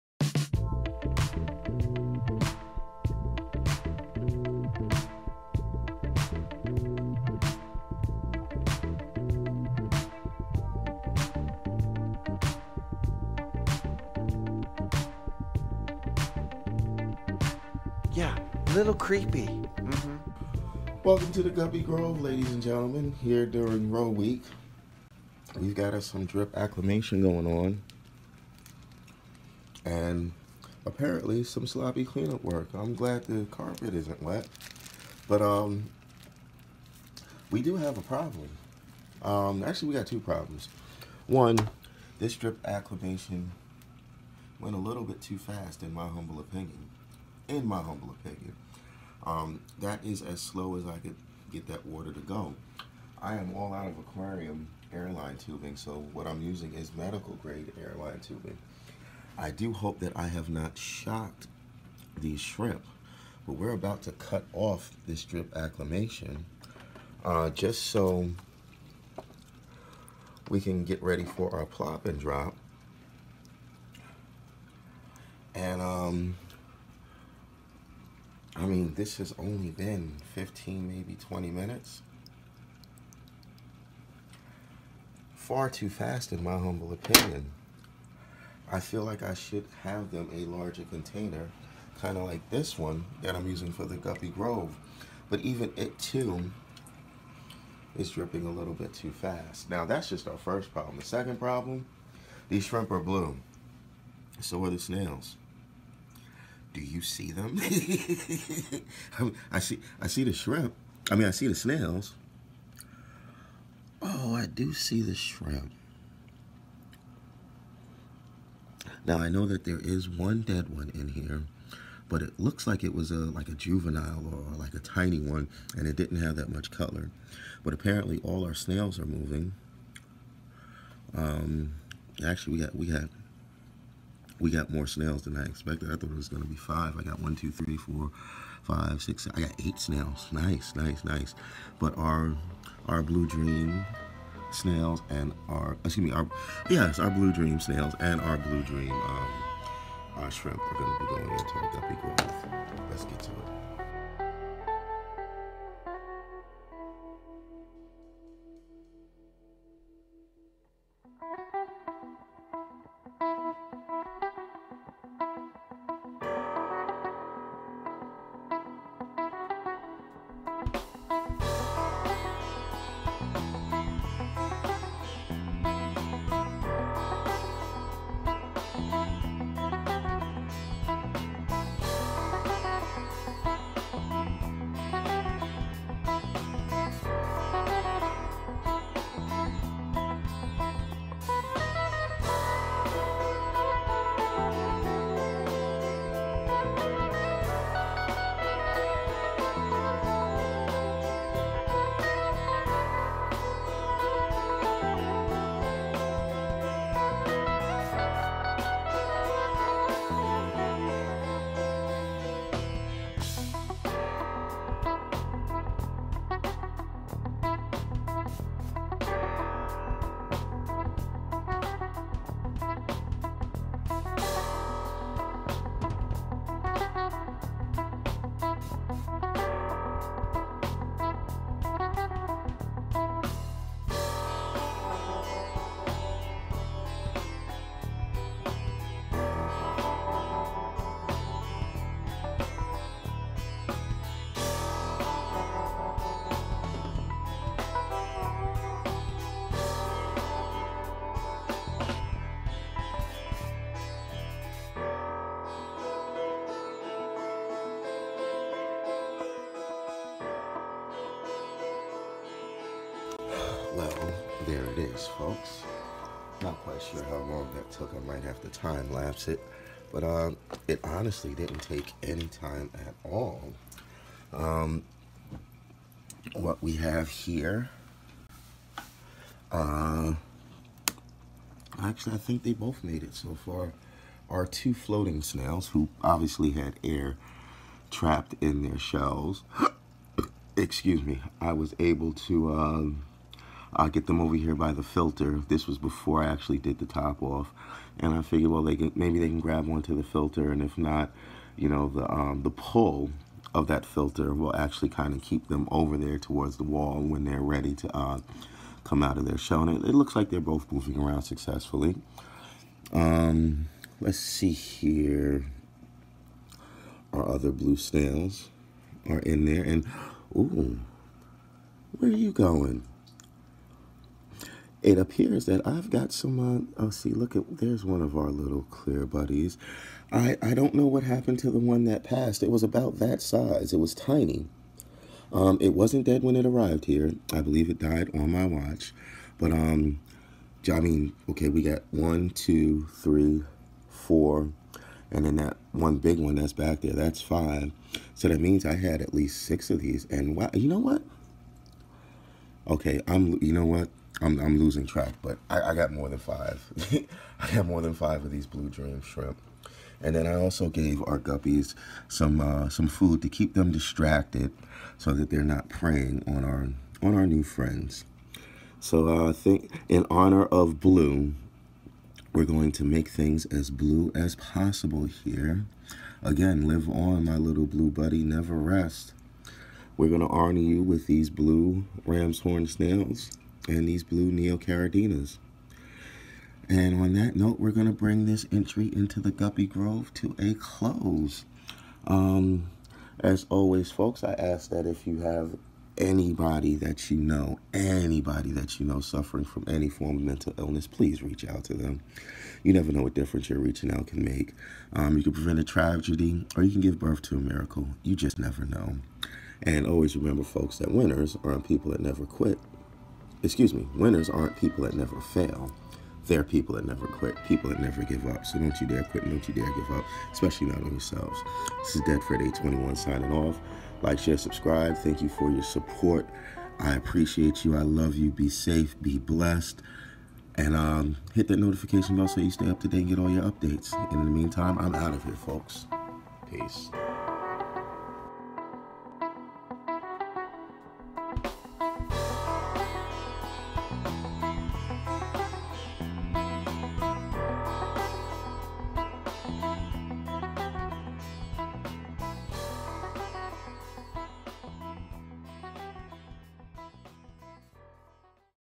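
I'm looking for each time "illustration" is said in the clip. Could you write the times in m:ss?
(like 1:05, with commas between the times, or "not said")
not said.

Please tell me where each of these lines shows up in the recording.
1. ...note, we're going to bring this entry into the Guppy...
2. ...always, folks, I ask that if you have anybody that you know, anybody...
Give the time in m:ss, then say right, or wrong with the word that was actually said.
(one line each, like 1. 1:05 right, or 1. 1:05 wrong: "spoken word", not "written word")
1. 6:27 right
2. 6:33 right.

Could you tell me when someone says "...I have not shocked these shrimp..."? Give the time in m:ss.
1:00.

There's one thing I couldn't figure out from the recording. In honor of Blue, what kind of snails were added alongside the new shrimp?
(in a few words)
Blue ram's horn snails.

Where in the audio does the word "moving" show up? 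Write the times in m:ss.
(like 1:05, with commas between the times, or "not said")
2:09, 5:10.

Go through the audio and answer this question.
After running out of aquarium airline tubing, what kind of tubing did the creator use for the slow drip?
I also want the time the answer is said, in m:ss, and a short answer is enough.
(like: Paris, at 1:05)
Medical grade airline tubing, at 0:56.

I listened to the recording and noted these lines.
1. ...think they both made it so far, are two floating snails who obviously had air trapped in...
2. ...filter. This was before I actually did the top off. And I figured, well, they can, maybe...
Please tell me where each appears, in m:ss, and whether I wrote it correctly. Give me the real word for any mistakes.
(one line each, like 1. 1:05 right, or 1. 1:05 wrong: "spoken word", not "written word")
1. 4:42 right
2. 4:54 right.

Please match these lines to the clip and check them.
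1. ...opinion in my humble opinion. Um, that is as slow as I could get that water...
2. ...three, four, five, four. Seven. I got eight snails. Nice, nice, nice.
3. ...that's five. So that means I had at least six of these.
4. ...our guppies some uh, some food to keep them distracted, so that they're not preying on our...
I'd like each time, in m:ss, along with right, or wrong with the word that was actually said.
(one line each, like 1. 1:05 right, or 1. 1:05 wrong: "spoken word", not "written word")
1. 0:46 right
2. 2:17 wrong: "six", not "four"
3. 5:46 right
4. 6:01 right.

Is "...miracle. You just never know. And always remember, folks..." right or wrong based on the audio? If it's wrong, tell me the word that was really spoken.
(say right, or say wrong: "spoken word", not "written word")
right.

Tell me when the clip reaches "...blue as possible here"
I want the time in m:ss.
6:13.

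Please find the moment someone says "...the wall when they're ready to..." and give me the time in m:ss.
5:06.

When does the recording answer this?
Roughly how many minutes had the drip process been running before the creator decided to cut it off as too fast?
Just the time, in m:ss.
1:20.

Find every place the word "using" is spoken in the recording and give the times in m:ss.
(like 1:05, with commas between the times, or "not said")
0:56, 1:33.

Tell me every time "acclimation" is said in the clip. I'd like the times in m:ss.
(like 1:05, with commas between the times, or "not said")
0:26, 0:42, 1:05.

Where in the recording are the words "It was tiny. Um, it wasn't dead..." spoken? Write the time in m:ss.
5:33.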